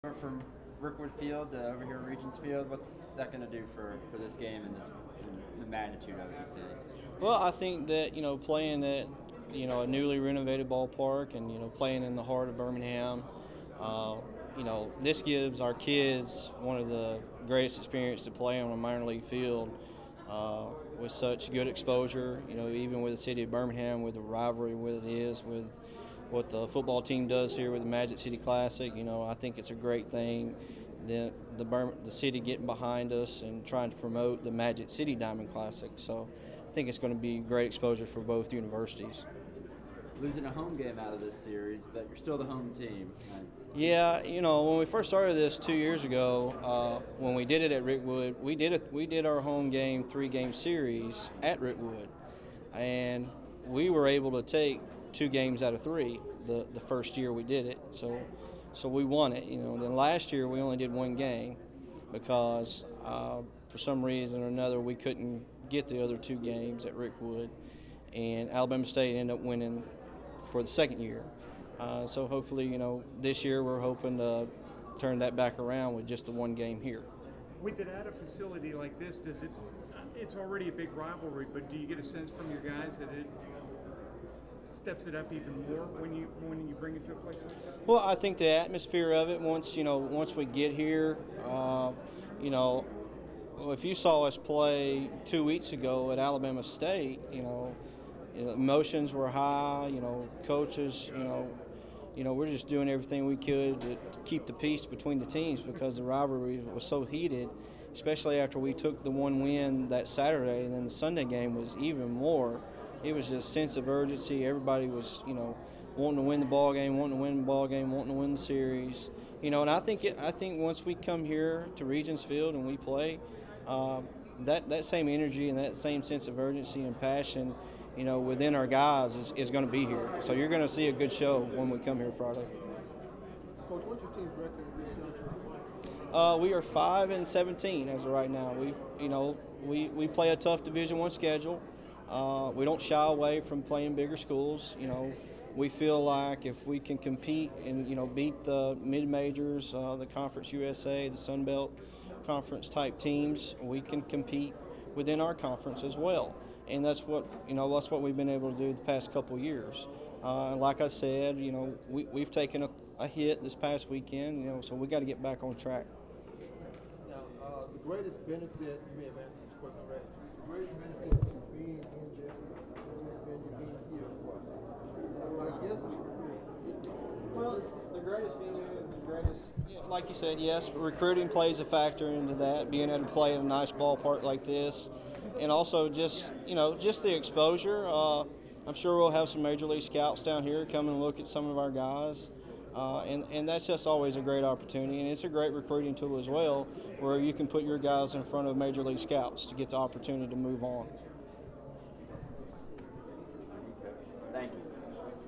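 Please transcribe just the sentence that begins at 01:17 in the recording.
With it at a facility like this, does it?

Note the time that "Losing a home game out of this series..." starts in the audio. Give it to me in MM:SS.
00:40.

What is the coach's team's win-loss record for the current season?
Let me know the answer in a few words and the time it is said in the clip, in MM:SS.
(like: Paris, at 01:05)
5 and 17, at 02:16.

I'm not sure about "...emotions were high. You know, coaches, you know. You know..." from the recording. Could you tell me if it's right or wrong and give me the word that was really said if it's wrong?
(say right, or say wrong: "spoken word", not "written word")
right.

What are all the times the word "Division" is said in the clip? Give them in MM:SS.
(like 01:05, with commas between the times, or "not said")
02:20.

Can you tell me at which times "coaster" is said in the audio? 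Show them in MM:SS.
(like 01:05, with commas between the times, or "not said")
not said.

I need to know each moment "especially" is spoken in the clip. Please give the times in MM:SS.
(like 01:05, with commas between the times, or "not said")
01:47.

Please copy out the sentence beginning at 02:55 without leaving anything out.
I guess well, the greatest venue, the greatest, like you said, yes, recruiting plays a factor into that.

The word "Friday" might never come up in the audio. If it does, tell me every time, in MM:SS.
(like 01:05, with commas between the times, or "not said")
02:12.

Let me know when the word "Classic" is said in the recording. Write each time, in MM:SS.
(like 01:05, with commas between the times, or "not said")
00:28, 00:35.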